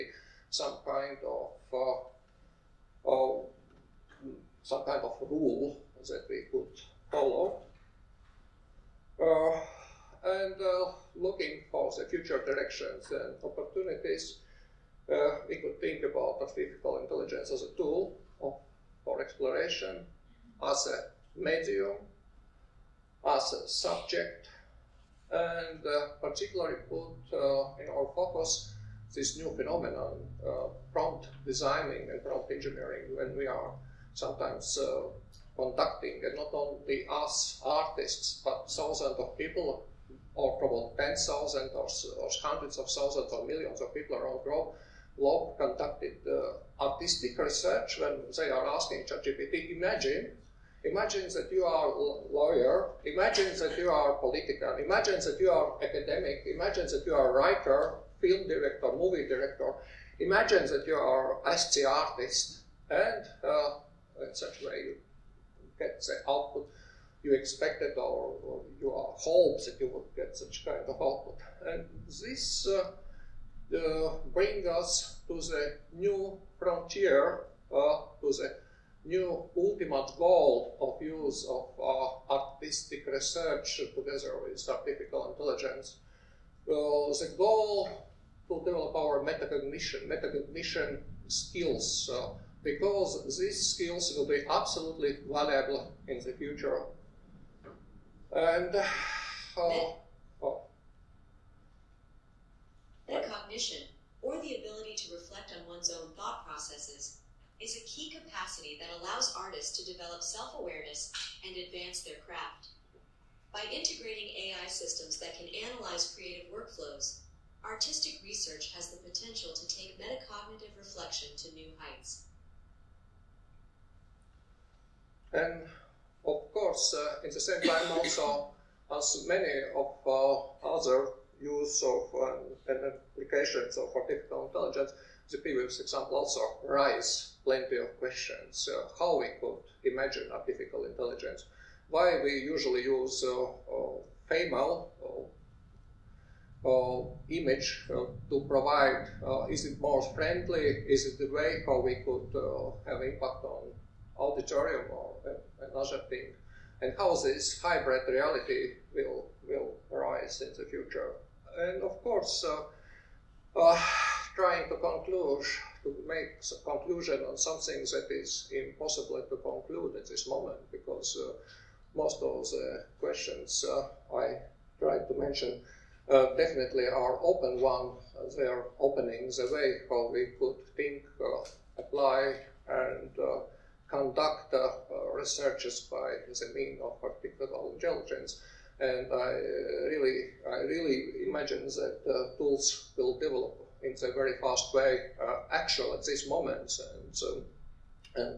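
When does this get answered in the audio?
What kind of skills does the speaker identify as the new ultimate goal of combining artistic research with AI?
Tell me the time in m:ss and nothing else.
1:30.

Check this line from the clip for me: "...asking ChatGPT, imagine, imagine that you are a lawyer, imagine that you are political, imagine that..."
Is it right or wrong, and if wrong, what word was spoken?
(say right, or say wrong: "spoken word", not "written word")
right.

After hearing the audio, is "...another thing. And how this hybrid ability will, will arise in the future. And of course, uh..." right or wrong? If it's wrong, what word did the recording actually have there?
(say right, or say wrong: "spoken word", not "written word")
wrong: "reality", not "ability".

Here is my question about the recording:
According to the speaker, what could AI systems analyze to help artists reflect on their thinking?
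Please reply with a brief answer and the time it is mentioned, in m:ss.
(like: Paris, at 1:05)
Creative workflows, at 1:56.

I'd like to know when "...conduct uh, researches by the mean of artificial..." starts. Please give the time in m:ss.
3:03.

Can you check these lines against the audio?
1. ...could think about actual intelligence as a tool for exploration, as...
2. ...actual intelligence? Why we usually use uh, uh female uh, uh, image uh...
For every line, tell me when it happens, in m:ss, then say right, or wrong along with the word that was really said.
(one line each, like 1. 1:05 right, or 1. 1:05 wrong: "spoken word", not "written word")
1. 0:15 wrong: "artificial", not "actual"
2. 2:20 wrong: "artificial", not "actual".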